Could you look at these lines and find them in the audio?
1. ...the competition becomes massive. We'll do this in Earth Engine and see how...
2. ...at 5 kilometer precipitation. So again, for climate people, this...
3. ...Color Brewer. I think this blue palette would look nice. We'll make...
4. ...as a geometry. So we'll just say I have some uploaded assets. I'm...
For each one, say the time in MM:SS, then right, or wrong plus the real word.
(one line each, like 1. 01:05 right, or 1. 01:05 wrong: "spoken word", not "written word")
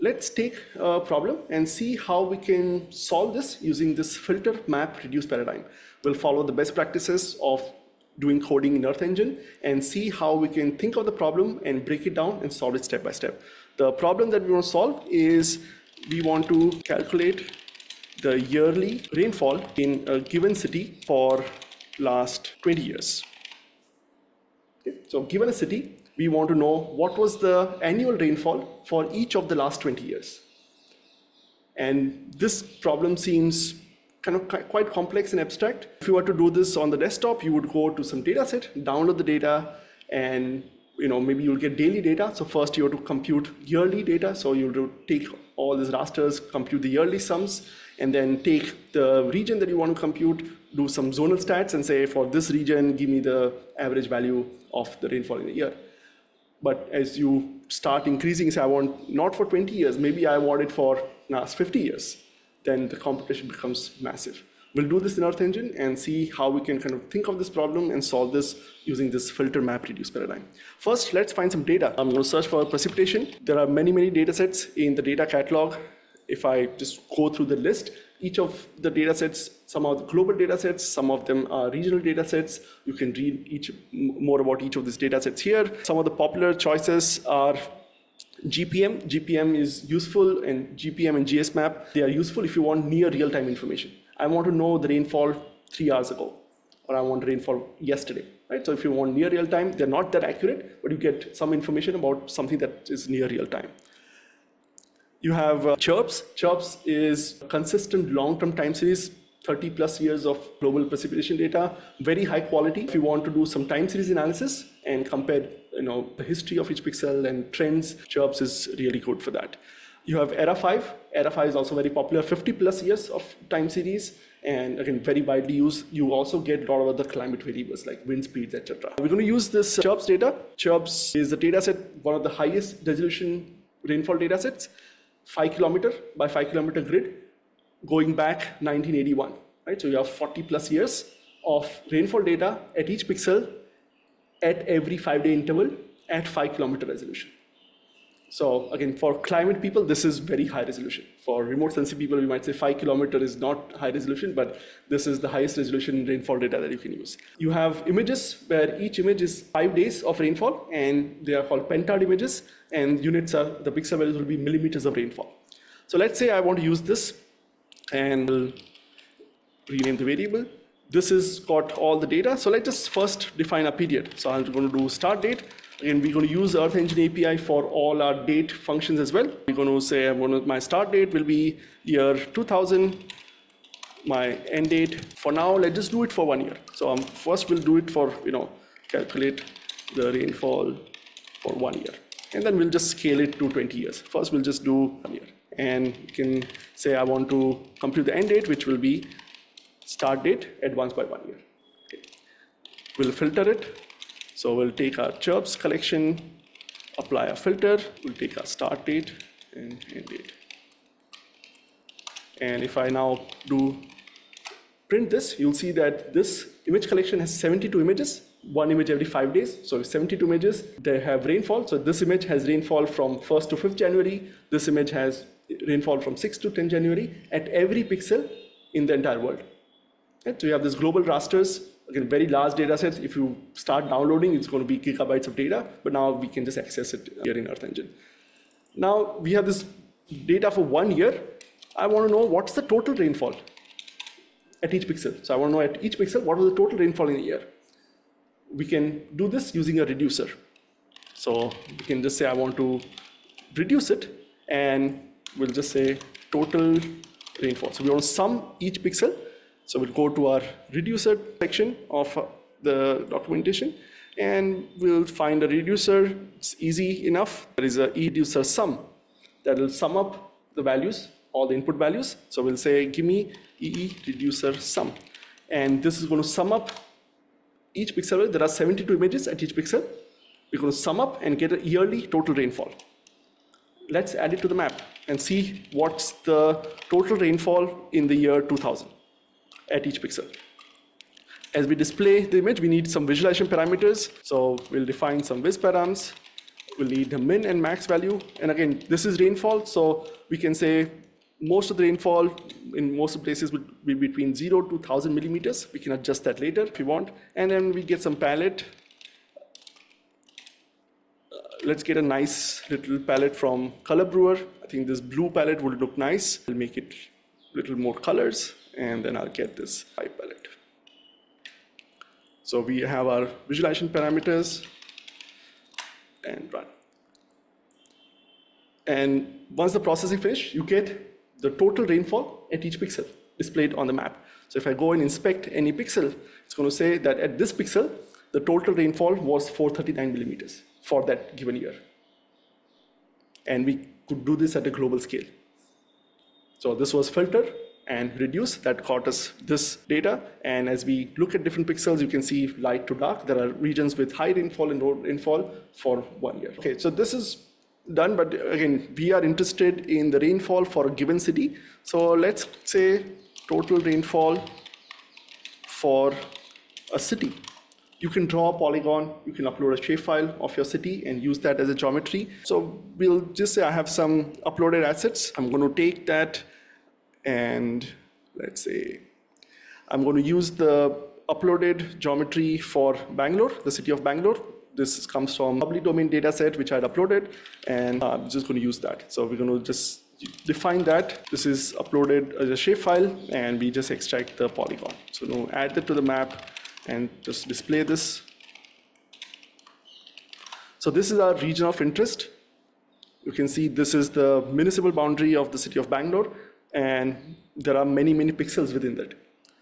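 1. 01:02 right
2. 02:26 wrong: "resolution", not "precipitation"
3. 05:13 right
4. 06:11 right.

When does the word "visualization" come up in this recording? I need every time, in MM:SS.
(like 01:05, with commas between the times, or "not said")
04:53, 05:23.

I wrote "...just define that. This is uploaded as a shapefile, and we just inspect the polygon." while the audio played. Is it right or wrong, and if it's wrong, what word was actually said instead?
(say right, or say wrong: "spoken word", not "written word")
wrong: "extract", not "inspect".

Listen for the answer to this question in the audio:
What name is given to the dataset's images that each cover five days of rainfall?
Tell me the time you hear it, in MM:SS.
02:41.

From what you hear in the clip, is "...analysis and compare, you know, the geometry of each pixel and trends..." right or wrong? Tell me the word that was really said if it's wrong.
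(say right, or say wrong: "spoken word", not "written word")
wrong: "history", not "geometry".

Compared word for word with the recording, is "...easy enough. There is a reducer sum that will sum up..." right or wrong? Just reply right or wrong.
right.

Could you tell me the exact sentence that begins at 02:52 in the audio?
So let's just first define a period.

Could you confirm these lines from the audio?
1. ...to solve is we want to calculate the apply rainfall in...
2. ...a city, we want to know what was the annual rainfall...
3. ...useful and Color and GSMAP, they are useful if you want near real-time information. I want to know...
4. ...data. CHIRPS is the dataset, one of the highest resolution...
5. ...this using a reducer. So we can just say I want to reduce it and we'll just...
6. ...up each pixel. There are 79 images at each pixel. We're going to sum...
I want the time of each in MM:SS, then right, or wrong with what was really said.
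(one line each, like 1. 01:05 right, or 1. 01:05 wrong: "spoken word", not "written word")
1. 00:14 wrong: "yearly", not "apply"
2. 00:25 right
3. 01:29 wrong: "GPM", not "Color"
4. 02:10 right
5. 04:09 right
6. 04:36 wrong: "72", not "79".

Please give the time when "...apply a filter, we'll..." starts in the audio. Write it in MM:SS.
03:26.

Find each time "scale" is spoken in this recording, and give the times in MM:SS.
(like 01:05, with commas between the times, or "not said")
03:12, 05:44.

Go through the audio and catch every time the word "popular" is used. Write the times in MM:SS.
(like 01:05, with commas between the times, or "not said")
01:26, 02:01.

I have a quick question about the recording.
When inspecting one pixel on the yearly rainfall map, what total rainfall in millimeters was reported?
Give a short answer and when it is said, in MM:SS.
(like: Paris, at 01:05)
439, at 05:39.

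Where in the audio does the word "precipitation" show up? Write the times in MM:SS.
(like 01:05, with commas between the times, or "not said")
01:12, 01:50.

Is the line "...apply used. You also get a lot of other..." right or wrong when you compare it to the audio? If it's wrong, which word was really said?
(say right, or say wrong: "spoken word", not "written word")
wrong: "widely", not "apply".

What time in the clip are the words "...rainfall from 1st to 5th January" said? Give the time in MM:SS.
03:42.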